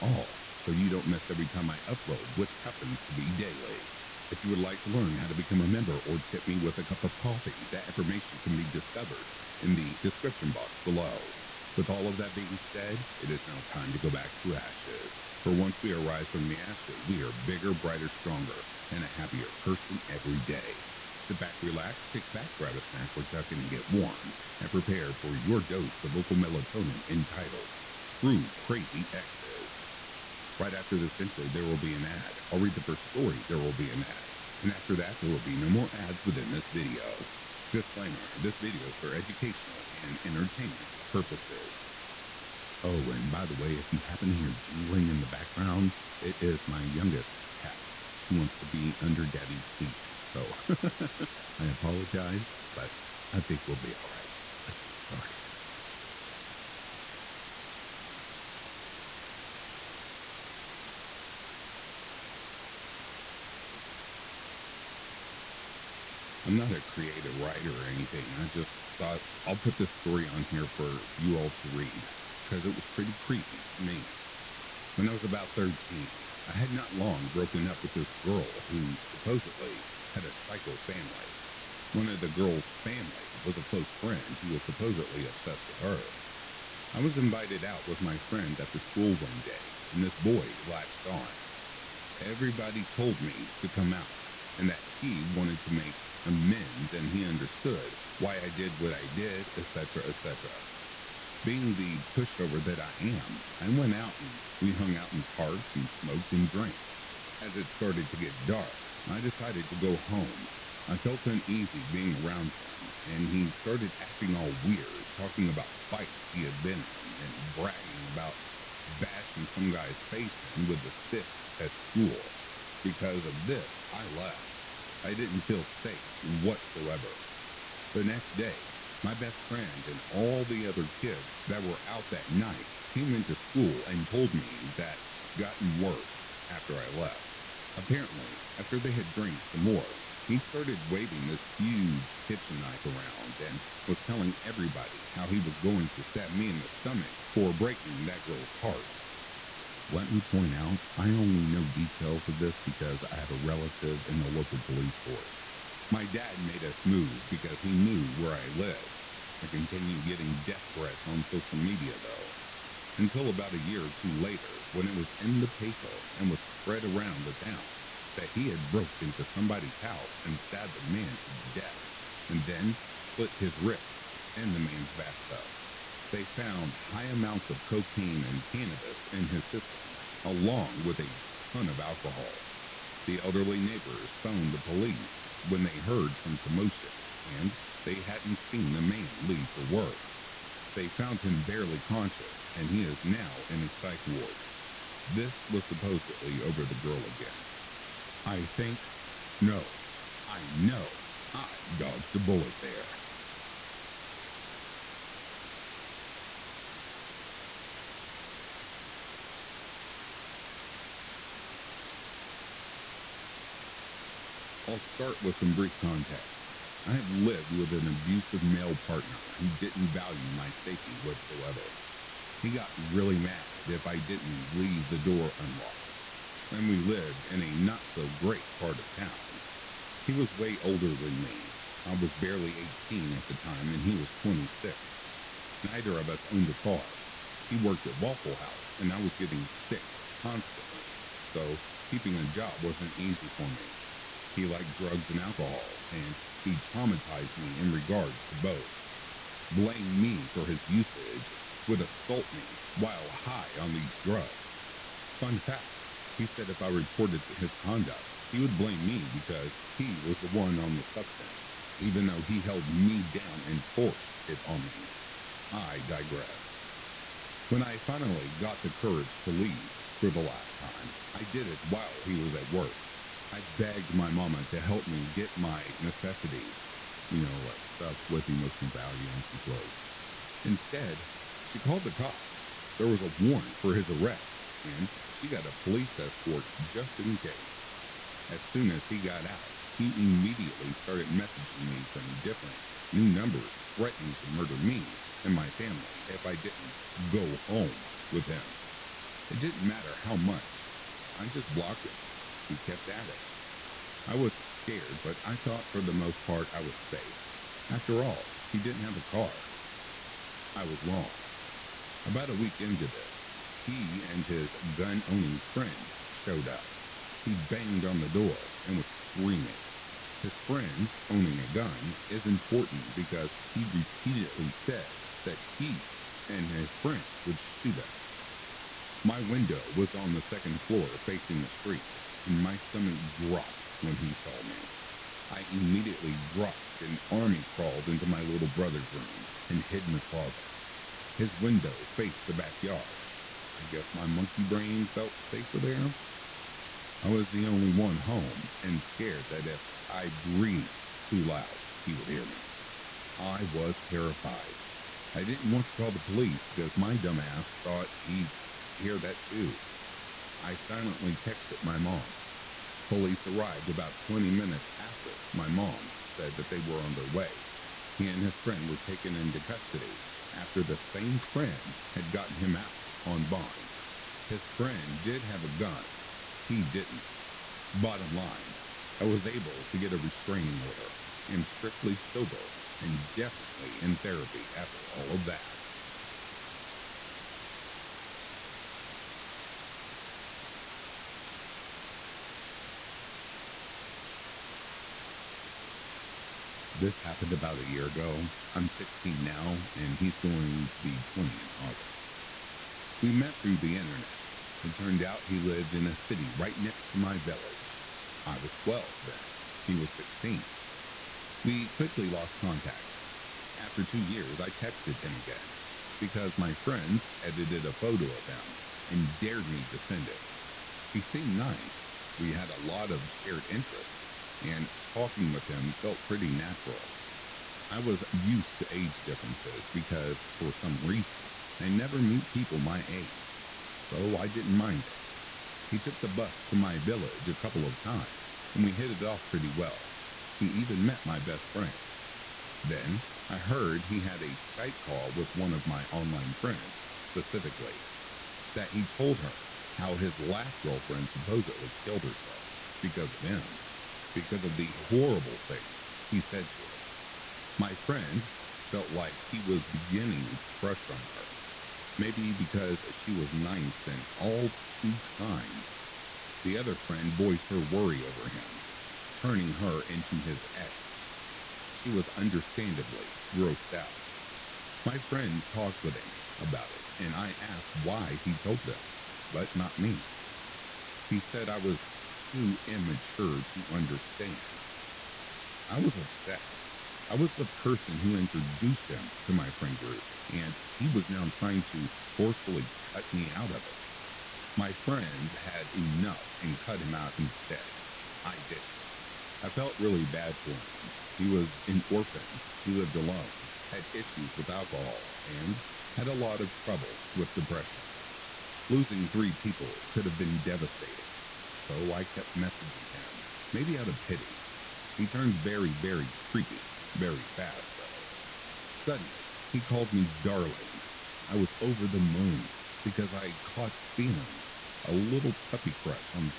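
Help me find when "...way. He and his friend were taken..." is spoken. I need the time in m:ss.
6:07.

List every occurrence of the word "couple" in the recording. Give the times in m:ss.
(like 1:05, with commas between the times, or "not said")
7:17.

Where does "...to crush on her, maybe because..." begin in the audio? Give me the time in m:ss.
7:40.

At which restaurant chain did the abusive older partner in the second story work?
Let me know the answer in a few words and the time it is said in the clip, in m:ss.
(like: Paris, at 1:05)
Waffle House, at 3:57.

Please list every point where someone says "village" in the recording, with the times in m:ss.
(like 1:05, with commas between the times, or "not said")
6:47, 7:16.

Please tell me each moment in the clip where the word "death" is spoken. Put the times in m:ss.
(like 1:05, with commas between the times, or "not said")
2:40, 2:51.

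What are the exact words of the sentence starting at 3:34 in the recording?
I'll start with some brief context.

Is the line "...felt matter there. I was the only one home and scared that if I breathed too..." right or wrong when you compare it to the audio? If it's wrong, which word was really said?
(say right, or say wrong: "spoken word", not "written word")
wrong: "safer", not "matter".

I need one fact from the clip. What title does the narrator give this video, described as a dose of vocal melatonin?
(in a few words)
True Crazy Exes.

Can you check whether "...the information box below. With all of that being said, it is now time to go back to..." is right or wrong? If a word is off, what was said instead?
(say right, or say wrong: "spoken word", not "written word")
wrong: "description", not "information".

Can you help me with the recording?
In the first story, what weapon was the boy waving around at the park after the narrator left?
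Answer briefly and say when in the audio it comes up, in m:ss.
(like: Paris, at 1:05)
Kitchen knife, at 2:22.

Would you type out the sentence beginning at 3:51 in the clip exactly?
I was barely 18 at the time, and he was 26.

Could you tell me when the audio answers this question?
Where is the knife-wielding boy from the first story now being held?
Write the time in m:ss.
3:13.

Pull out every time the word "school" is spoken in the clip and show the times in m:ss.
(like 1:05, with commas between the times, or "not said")
1:28, 2:01, 2:13.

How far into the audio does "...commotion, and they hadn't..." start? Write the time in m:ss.
3:06.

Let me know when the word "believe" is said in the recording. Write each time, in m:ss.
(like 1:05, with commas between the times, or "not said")
not said.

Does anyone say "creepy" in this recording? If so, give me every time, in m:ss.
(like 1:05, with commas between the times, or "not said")
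1:13, 8:36.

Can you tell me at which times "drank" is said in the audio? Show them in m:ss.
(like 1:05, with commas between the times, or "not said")
1:46, 2:19.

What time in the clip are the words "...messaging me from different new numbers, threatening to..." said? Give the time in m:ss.
4:51.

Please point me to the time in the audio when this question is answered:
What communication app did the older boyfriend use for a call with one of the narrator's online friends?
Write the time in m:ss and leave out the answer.
7:24.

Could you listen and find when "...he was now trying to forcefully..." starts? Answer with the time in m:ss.
8:10.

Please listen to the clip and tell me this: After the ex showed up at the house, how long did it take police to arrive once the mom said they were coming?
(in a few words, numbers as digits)
20 minutes.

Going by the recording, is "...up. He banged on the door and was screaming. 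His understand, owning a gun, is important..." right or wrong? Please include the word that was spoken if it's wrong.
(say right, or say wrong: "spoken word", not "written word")
wrong: "friend", not "understand".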